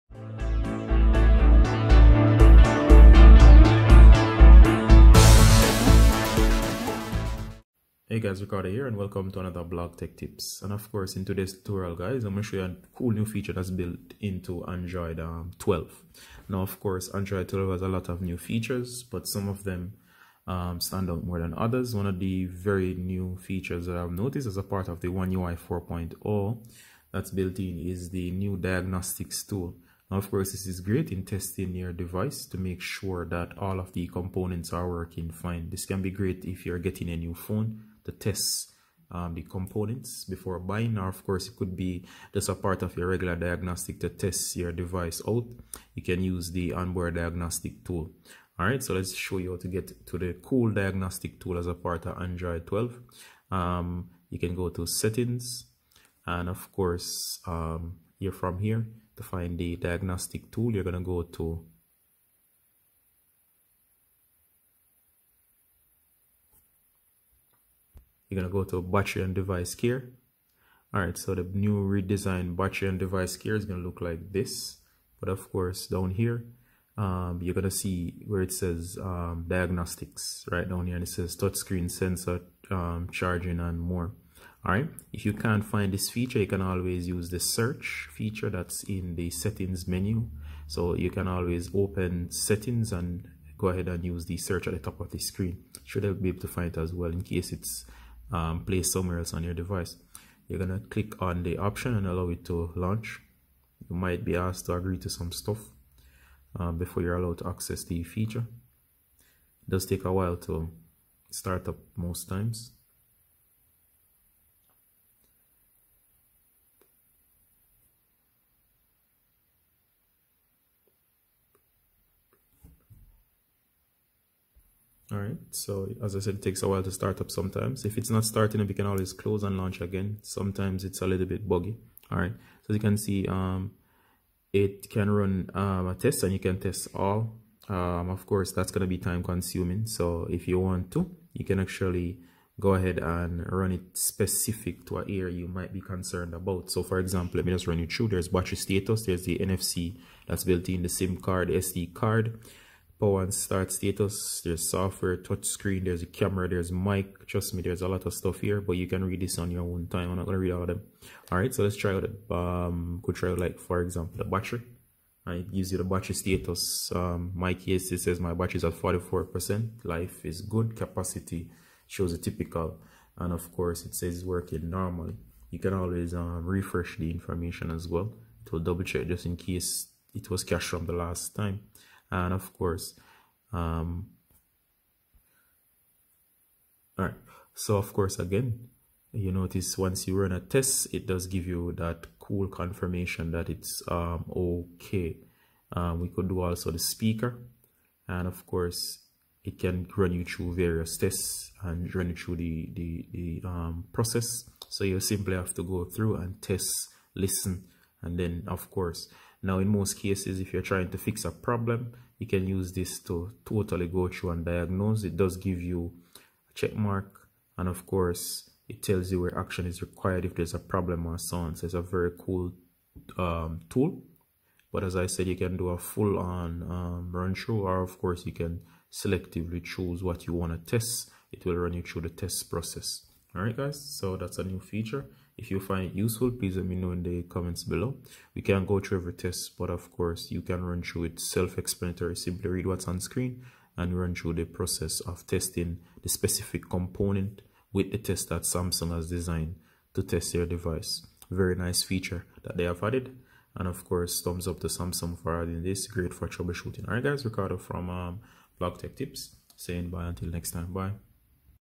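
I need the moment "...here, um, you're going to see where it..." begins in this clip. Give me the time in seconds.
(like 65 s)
76 s.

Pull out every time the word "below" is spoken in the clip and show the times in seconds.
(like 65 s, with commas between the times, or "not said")
237 s.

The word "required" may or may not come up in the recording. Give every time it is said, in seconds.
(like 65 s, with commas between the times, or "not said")
219 s.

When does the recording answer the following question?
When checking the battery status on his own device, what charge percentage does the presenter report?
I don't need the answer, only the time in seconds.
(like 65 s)
168 s.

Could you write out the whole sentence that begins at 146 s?
So for example, let me just run you through.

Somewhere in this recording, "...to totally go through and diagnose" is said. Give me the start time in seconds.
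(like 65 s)
213 s.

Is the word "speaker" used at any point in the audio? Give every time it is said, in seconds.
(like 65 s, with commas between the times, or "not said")
196 s.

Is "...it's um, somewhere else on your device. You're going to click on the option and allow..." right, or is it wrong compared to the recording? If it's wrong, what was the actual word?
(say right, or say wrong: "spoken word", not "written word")
right.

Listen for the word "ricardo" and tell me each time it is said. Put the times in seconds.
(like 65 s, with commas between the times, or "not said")
8 s, 257 s.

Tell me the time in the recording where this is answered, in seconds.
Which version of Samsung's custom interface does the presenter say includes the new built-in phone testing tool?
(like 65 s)
25 s.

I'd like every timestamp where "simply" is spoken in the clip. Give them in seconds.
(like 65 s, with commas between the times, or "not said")
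204 s, 242 s.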